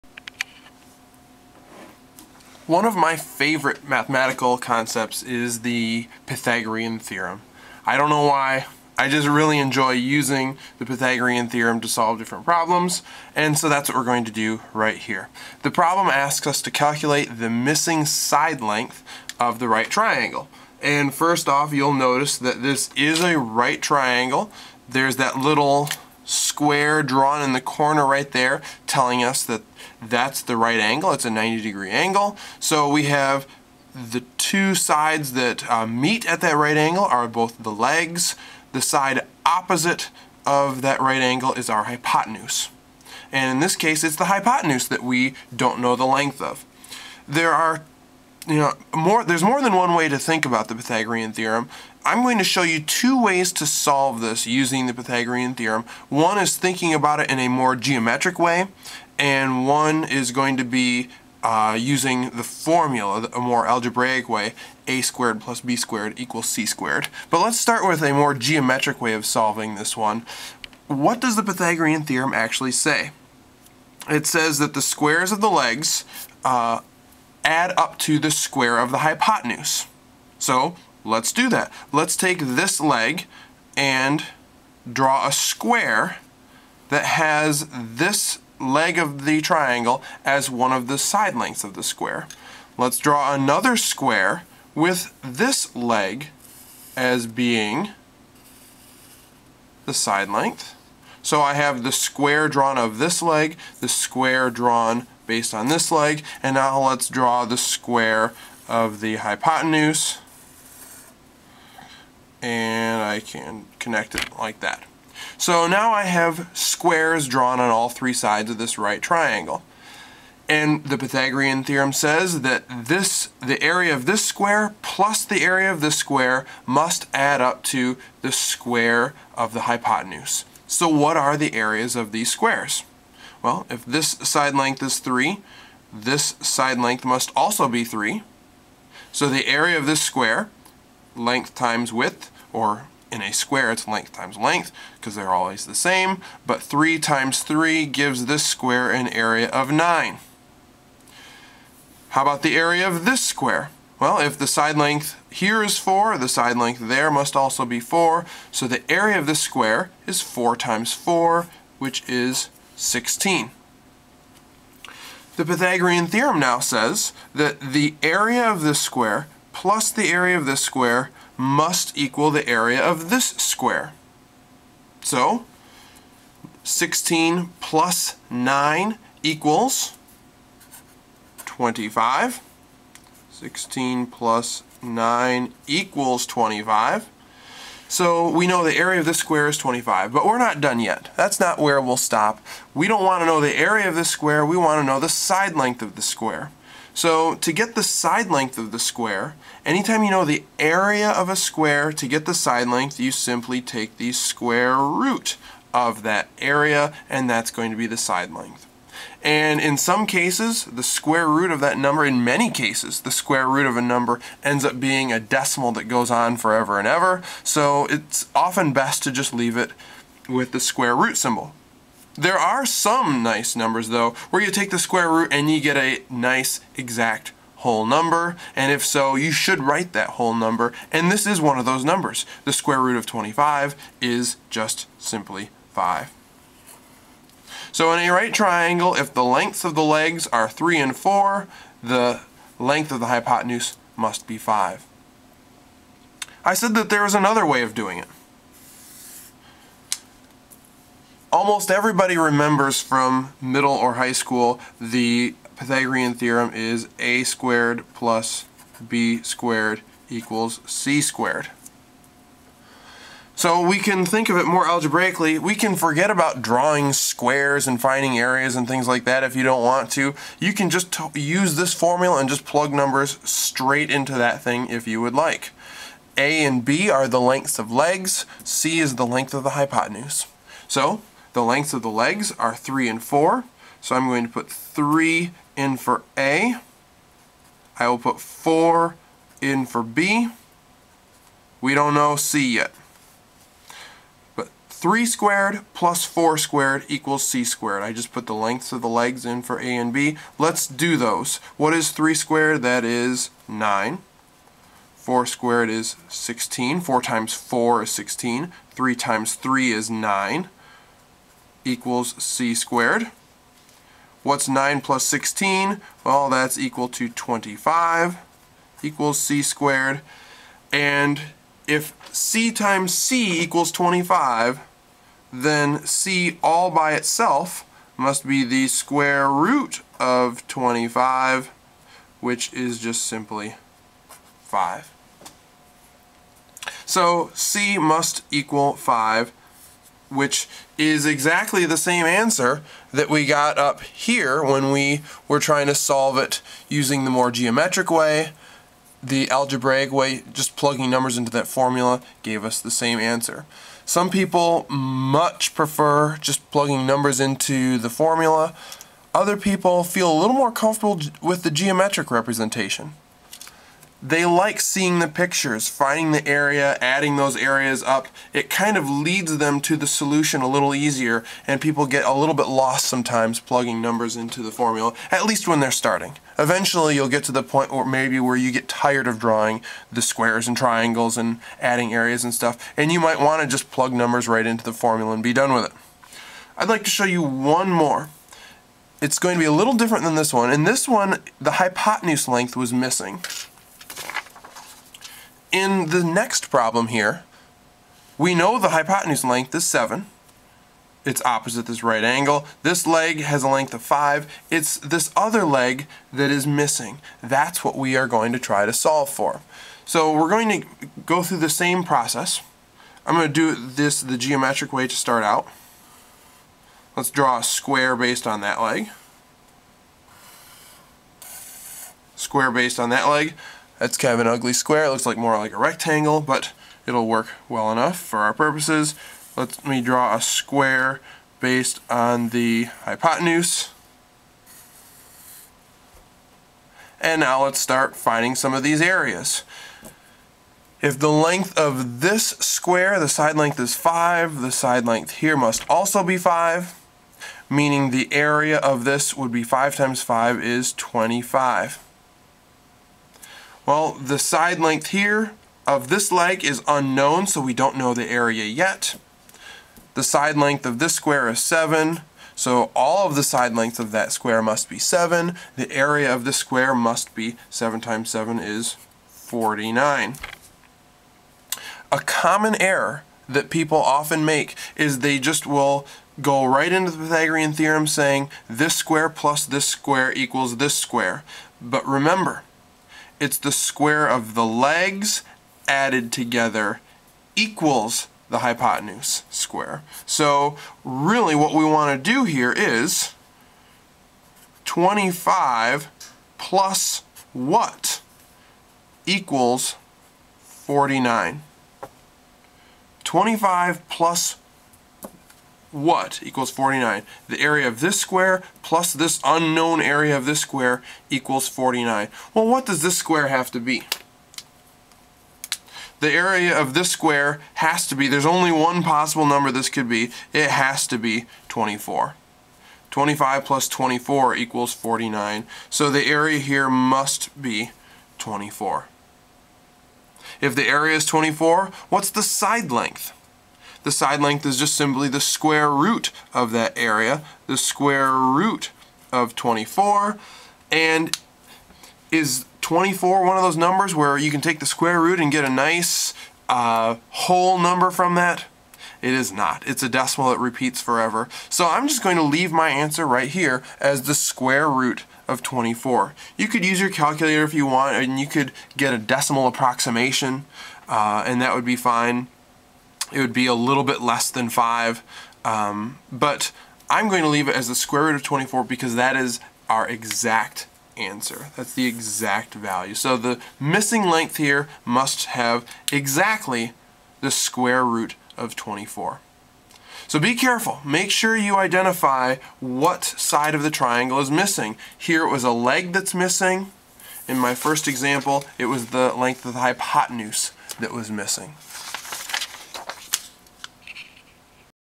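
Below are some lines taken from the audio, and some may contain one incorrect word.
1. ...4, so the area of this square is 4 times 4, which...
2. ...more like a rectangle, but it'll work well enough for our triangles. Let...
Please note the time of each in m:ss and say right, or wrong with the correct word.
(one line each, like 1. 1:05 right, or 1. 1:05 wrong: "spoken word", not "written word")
1. 2:37 right
2. 7:05 wrong: "purposes", not "triangles".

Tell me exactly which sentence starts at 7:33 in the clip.
Well, the side length here of this leg is unknown, so we don't know the area yet.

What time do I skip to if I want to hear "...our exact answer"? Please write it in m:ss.
9:29.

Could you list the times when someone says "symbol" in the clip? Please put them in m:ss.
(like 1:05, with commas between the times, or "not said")
3:41.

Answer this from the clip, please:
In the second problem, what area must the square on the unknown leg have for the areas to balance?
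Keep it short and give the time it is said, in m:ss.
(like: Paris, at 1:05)
24, at 8:40.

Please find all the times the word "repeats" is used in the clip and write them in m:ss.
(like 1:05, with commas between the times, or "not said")
9:10.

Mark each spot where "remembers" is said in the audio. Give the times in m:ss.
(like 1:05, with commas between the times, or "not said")
4:12, 8:01.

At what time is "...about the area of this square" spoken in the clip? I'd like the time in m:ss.
2:32.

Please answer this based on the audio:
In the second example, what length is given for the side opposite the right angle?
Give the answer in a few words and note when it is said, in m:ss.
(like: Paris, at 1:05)
7, at 6:38.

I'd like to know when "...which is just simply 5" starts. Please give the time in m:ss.
5:32.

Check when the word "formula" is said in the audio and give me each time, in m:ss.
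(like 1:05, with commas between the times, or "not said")
1:02, 4:31, 5:51, 5:57, 6:14, 6:24.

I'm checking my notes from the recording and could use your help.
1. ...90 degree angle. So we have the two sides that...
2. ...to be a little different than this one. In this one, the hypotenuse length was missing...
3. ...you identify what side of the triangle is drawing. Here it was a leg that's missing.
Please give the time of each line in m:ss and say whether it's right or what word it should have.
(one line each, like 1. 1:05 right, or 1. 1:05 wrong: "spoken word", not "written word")
1. 0:31 right
2. 6:29 right
3. 9:41 wrong: "missing", not "drawing".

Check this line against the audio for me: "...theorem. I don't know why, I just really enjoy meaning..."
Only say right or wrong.
wrong.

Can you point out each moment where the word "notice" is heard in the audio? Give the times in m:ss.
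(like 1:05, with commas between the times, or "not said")
0:21.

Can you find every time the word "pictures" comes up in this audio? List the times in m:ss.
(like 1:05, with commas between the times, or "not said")
6:05.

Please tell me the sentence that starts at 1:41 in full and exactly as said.
So I have the square drawn of this leg, the square drawn based on this leg.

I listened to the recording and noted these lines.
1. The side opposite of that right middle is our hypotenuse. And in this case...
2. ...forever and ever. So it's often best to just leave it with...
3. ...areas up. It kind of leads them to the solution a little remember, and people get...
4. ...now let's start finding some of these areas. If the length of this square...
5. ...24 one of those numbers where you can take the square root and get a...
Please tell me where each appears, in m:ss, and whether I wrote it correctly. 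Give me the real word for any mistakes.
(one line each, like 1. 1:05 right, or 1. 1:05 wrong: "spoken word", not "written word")
1. 0:38 wrong: "angle", not "middle"
2. 3:36 right
3. 6:07 wrong: "easier", not "remember"
4. 7:17 right
5. 9:02 right.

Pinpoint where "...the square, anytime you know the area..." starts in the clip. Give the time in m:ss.
3:18.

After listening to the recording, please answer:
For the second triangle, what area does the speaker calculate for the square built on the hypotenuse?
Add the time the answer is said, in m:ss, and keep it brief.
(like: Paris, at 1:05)
49, at 7:45.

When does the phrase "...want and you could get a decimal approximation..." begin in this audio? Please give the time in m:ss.
9:17.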